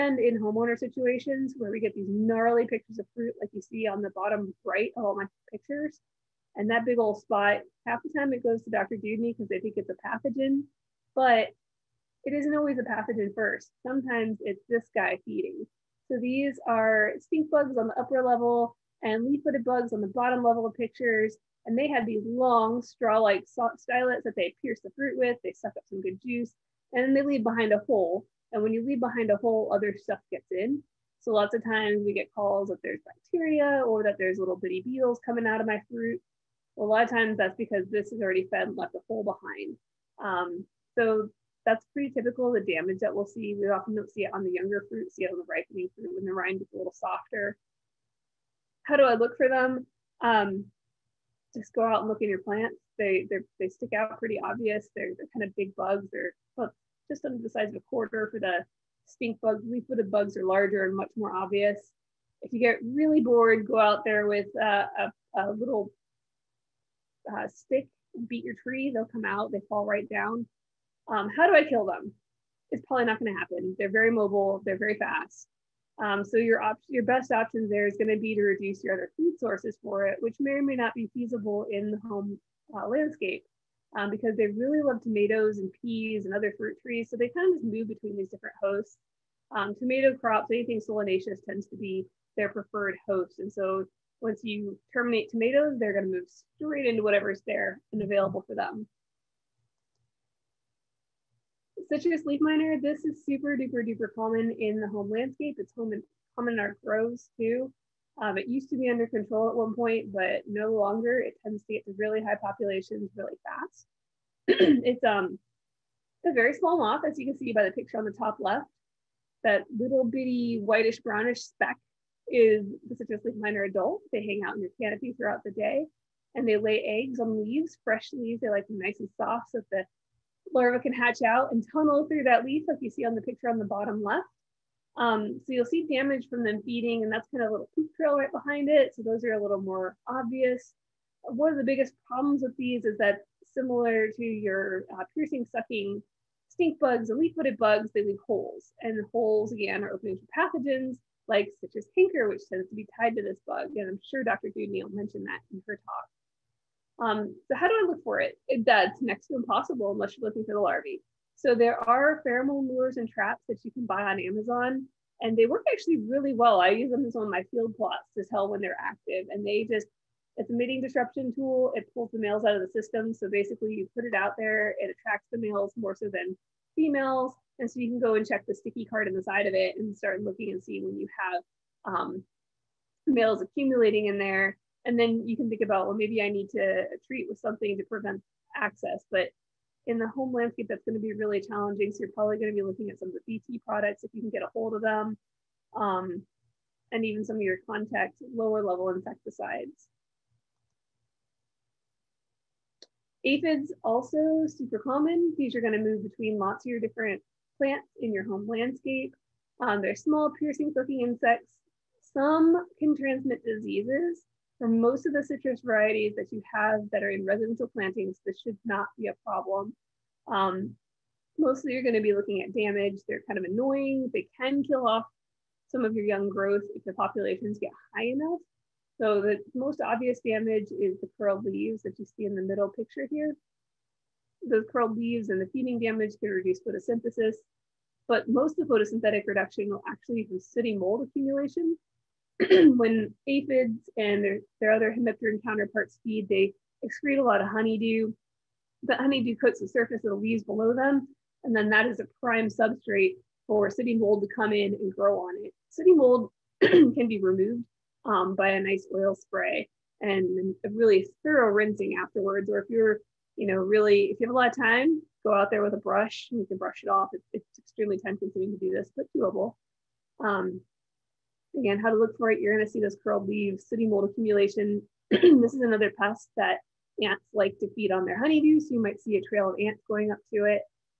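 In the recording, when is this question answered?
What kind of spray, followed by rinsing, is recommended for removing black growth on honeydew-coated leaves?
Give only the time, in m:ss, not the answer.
4:18.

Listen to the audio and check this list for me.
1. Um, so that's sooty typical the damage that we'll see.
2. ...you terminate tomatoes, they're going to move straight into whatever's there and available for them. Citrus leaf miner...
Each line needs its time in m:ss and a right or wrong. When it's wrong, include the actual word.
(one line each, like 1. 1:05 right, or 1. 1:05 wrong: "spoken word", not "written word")
1. 0:40 wrong: "pretty", not "sooty"
2. 1:34 right.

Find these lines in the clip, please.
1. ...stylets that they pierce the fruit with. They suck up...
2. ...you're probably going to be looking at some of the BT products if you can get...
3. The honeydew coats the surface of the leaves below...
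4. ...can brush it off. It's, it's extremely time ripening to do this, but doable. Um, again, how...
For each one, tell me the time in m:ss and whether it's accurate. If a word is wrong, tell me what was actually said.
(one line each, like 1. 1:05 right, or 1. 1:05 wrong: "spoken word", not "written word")
1. 0:23 right
2. 3:12 right
3. 4:08 right
4. 4:26 wrong: "consuming", not "ripening".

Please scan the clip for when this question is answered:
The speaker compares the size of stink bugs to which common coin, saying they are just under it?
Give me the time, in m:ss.
0:57.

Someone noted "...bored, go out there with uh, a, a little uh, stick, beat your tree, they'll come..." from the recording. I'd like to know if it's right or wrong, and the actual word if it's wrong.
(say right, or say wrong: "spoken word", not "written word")
right.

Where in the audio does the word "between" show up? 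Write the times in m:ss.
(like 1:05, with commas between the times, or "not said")
1:27, 3:26.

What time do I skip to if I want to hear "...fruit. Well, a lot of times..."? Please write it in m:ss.
0:35.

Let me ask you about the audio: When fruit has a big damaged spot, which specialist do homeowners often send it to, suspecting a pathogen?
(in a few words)
Dr. Dewdney.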